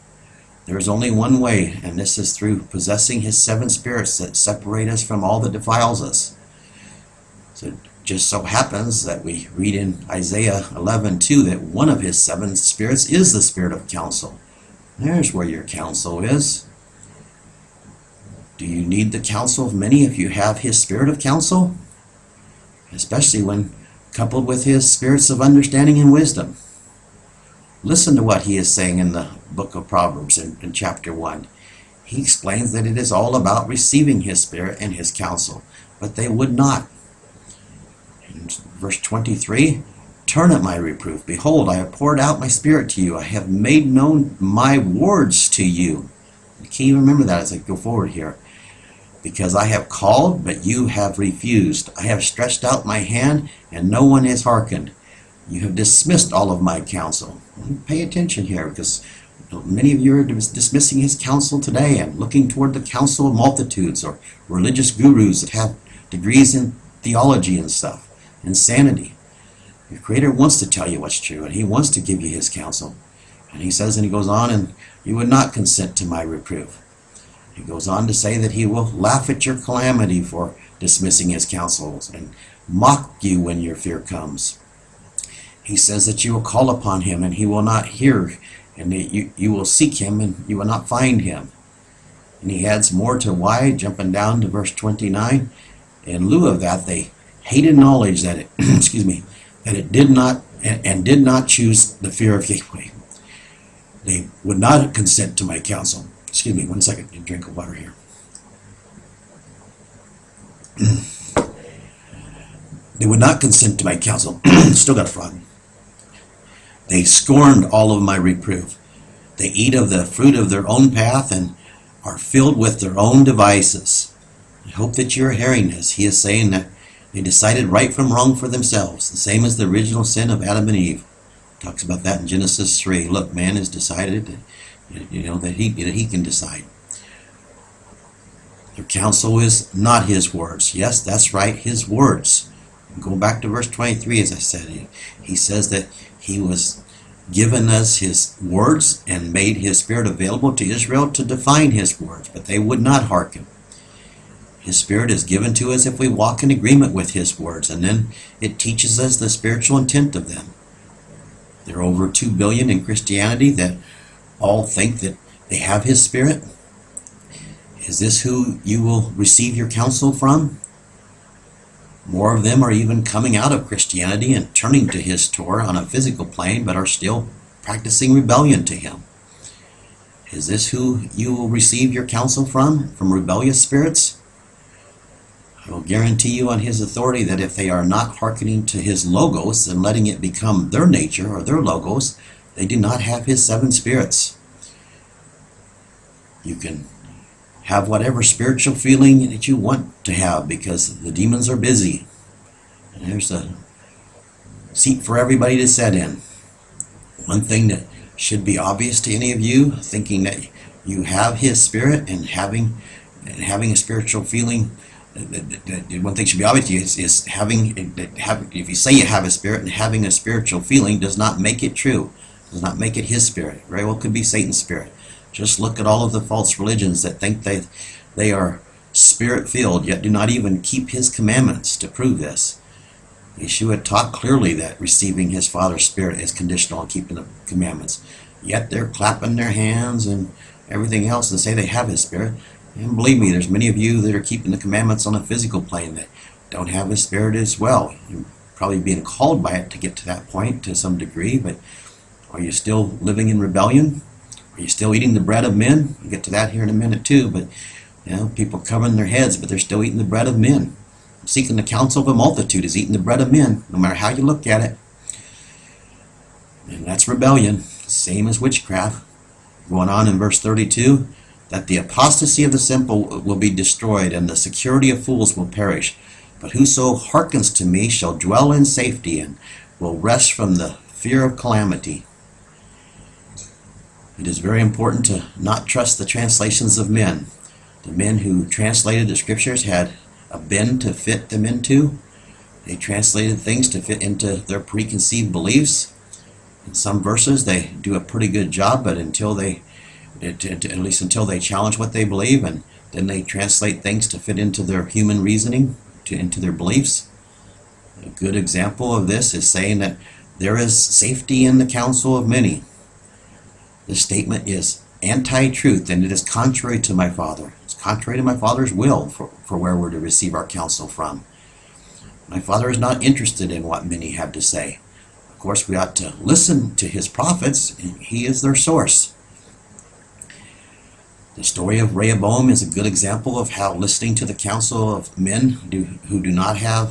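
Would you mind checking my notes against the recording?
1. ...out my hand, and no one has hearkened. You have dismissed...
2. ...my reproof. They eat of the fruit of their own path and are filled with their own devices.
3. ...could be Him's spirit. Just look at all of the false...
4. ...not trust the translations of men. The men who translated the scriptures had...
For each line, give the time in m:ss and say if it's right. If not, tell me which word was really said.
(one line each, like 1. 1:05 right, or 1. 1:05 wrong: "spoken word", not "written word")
1. 0:52 right
2. 1:58 right
3. 3:43 wrong: "Satan", not "Him"
4. 4:45 right.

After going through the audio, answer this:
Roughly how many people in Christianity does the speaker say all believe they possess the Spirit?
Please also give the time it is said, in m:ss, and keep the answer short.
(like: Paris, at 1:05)
Over 2 billion, at 2:41.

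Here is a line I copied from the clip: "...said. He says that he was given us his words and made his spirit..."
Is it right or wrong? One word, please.
right.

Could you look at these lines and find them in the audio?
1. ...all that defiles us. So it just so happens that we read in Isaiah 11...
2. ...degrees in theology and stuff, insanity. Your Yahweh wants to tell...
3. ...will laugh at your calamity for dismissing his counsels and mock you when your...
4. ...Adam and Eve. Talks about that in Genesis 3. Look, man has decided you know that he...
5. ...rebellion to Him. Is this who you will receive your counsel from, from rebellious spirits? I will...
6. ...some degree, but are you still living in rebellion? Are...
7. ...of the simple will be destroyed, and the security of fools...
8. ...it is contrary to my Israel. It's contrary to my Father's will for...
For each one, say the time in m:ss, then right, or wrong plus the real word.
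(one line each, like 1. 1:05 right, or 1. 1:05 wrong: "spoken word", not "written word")
1. 0:05 right
2. 1:06 wrong: "Creator", not "Yahweh"
3. 1:18 right
4. 2:10 right
5. 2:58 right
6. 4:10 right
7. 4:32 right
8. 5:16 wrong: "Father", not "Israel".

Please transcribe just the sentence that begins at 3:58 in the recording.
Yet they're clapping their hands and everything else and say they have his Spirit.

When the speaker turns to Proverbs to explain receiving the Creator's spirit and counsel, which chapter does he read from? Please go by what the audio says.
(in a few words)
Chapter 1.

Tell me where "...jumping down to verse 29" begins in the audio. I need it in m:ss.
1:33.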